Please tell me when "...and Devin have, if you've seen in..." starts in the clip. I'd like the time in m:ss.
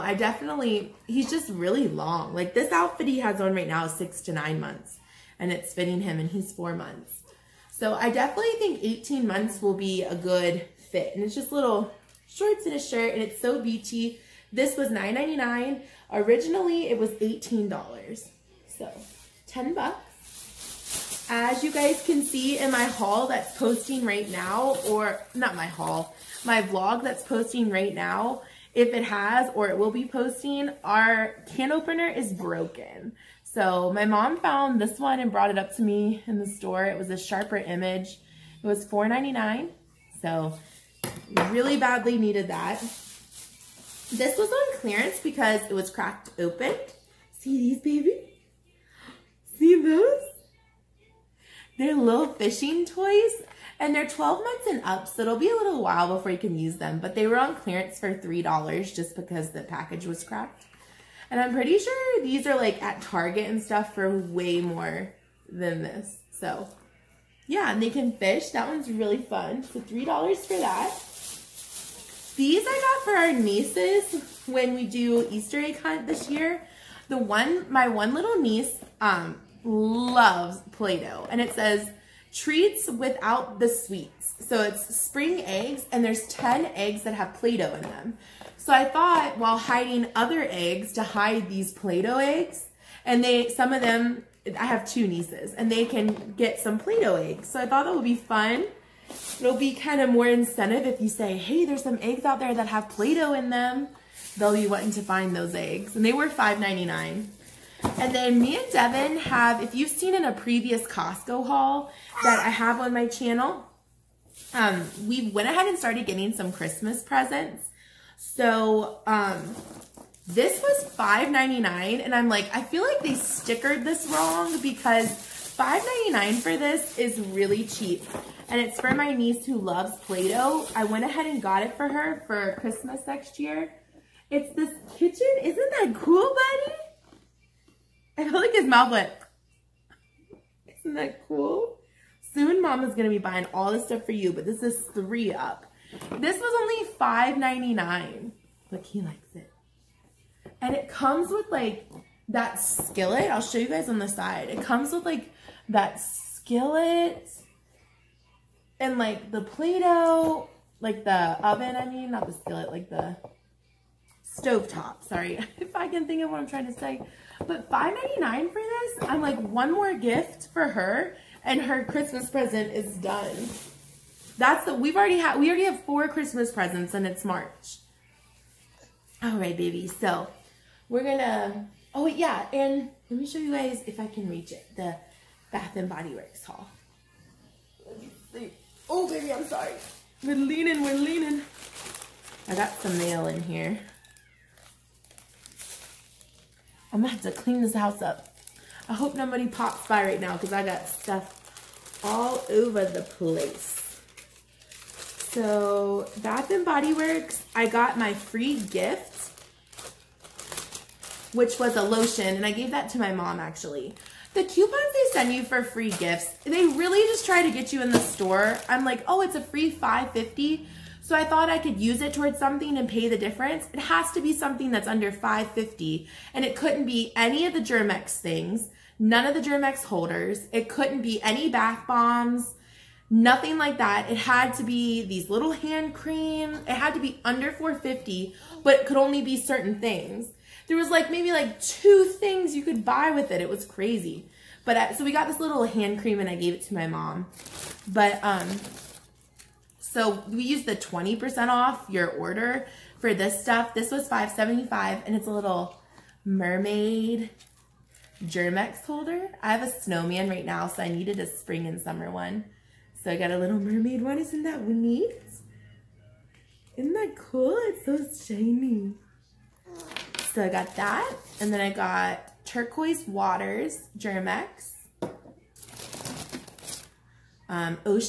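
1:48.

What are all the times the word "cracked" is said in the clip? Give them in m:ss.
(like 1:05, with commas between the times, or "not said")
0:45, 1:00.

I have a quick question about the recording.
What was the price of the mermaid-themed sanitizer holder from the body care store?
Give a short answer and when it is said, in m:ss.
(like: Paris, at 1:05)
$5.75, at 4:14.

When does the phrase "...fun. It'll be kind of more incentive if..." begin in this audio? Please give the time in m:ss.
1:38.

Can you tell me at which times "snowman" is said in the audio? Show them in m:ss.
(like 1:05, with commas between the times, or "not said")
4:19.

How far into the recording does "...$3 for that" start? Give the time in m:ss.
1:09.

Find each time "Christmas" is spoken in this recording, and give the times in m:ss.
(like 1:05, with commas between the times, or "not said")
1:56, 2:12, 2:51, 2:56.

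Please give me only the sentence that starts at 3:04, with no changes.
The Bath and Body Works haul.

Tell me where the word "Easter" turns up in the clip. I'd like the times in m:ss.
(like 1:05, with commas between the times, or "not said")
1:15.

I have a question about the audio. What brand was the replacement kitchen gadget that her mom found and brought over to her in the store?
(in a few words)
Sharper Image.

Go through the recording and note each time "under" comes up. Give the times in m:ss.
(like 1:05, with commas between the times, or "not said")
3:44, 3:57.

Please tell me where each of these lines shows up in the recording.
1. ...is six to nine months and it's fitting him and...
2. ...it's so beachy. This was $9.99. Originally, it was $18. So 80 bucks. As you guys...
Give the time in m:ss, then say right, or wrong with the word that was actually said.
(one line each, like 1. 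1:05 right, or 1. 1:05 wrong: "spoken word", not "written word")
1. 0:03 right
2. 0:13 wrong: "10", not "80".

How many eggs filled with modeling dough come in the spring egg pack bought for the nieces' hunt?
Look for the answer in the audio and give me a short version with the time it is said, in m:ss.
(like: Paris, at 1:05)
10, at 1:26.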